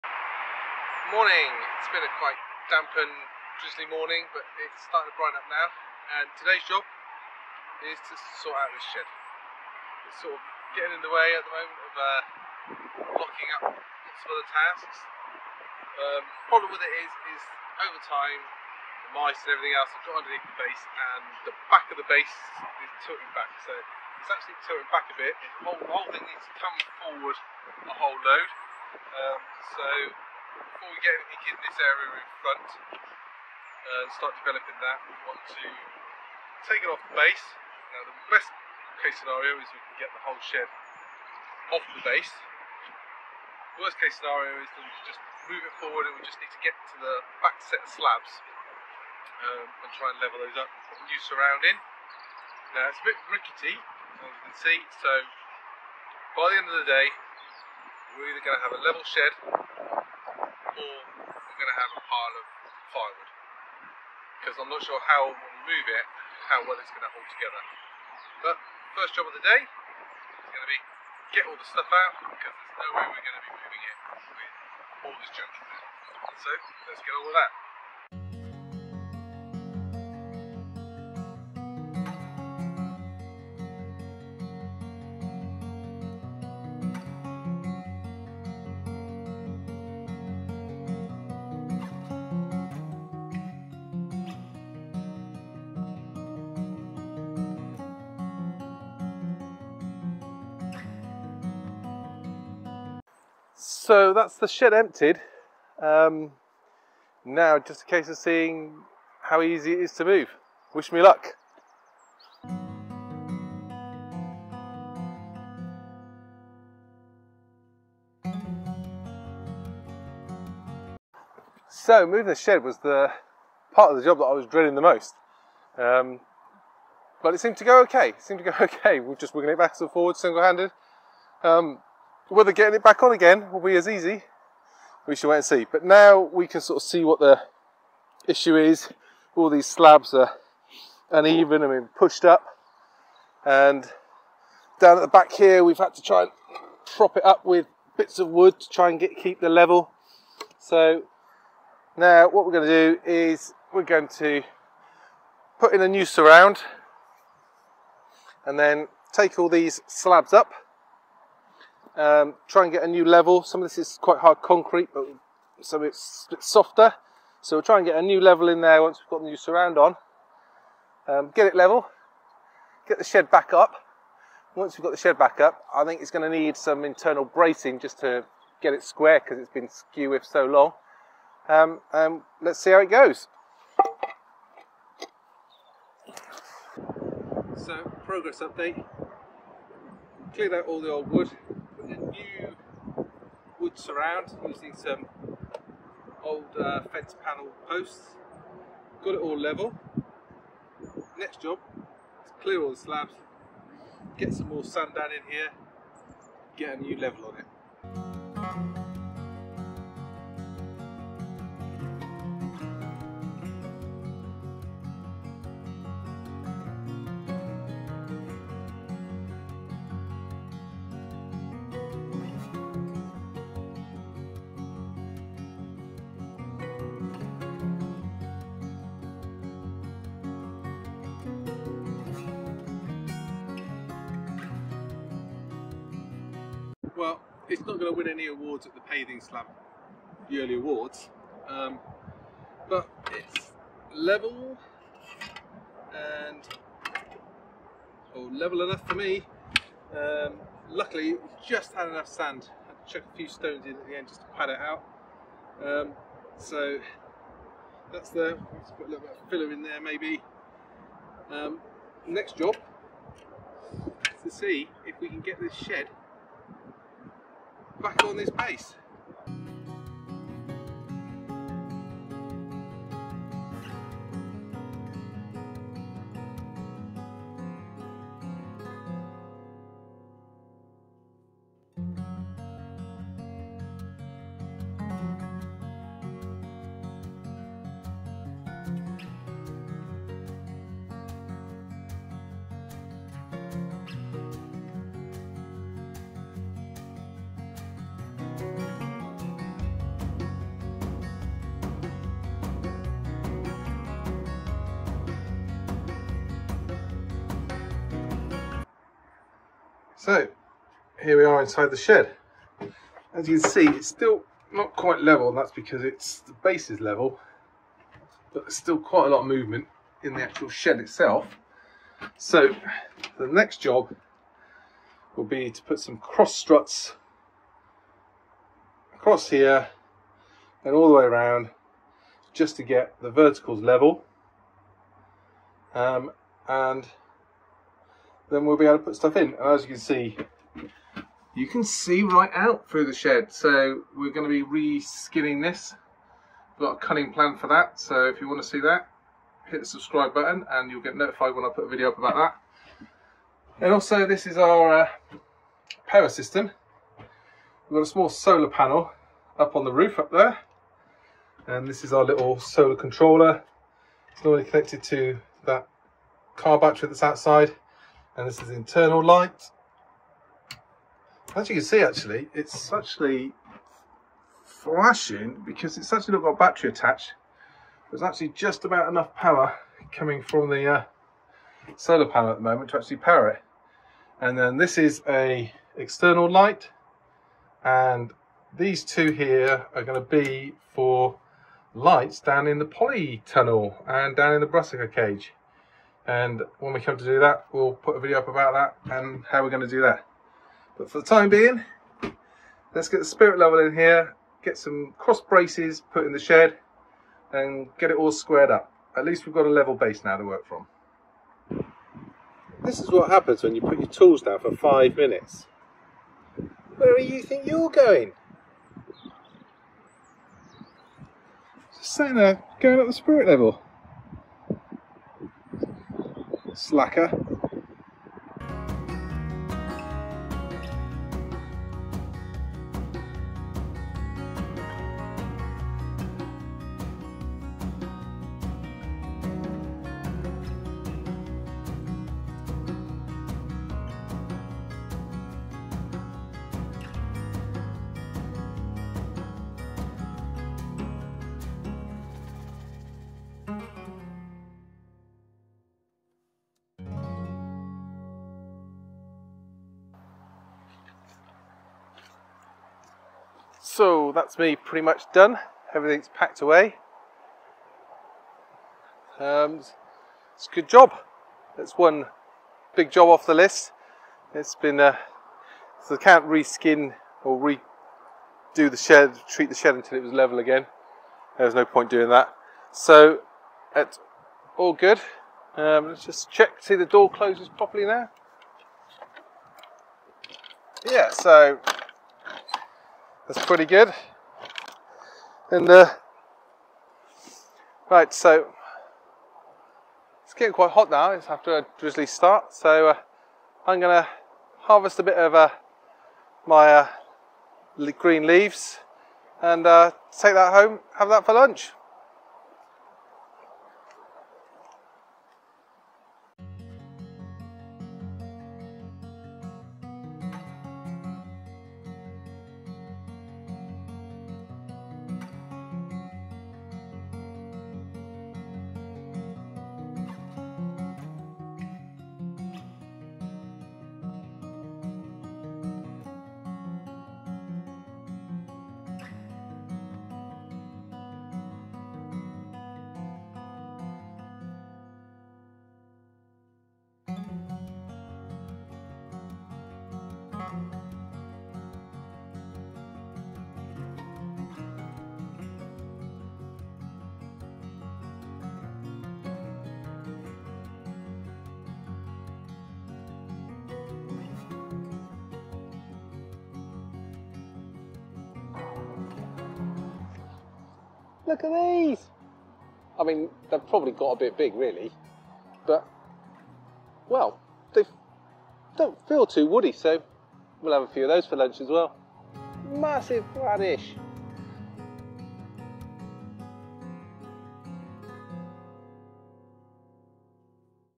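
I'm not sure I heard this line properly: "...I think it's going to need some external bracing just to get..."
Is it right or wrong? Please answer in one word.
wrong.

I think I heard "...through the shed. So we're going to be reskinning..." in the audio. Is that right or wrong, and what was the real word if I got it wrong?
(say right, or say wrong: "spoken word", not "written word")
right.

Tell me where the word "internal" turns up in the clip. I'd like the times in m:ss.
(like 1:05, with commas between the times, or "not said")
2:56, 6:08.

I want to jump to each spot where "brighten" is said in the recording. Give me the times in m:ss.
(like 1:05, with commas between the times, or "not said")
0:05.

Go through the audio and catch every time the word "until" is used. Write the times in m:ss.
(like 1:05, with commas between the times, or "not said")
7:59.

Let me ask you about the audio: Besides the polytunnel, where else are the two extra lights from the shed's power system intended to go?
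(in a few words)
brassica cage.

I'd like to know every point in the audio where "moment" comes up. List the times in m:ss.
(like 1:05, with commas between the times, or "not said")
0:11, 6:22.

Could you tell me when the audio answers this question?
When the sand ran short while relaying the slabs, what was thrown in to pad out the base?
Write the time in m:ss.
4:13.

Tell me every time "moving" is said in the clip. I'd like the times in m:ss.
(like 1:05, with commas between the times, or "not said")
1:13, 2:02.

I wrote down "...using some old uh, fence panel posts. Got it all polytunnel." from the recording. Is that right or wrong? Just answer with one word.
wrong.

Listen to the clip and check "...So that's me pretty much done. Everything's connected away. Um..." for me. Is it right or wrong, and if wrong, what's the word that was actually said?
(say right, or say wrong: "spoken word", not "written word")
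wrong: "packed", not "connected".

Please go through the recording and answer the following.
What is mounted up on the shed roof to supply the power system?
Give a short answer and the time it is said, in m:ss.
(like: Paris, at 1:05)
small solar panel, at 5:57.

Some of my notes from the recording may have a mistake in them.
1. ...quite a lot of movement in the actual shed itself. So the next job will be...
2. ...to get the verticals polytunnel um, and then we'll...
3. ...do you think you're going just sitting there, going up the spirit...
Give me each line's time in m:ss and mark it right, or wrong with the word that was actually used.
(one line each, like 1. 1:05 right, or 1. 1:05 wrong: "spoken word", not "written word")
1. 5:18 right
2. 5:32 wrong: "level", not "polytunnel"
3. 6:56 right.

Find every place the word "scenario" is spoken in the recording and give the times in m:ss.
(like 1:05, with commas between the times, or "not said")
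0:39, 0:44.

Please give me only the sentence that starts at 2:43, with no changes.
Some of this is quite hard concrete, but so it's a bit softer.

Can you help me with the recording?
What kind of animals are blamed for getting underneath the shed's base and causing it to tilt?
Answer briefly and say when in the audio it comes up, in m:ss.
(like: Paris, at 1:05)
mice, at 0:19.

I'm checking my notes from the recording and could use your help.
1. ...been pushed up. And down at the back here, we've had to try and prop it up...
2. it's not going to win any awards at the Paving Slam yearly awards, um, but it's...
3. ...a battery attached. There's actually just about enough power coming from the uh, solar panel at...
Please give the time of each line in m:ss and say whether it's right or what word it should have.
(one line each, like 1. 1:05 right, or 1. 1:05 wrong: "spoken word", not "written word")
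1. 2:21 right
2. 3:57 right
3. 6:16 right.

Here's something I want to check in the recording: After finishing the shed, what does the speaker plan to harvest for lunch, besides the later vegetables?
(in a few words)
green leaves.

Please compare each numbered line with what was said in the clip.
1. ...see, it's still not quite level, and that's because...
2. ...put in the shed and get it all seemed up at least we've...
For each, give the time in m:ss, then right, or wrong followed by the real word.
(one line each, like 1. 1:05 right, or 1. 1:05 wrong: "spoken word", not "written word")
1. 5:13 right
2. 6:45 wrong: "squared", not "seemed".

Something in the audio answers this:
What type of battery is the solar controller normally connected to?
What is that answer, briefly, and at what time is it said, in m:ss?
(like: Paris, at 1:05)
car battery, at 6:06.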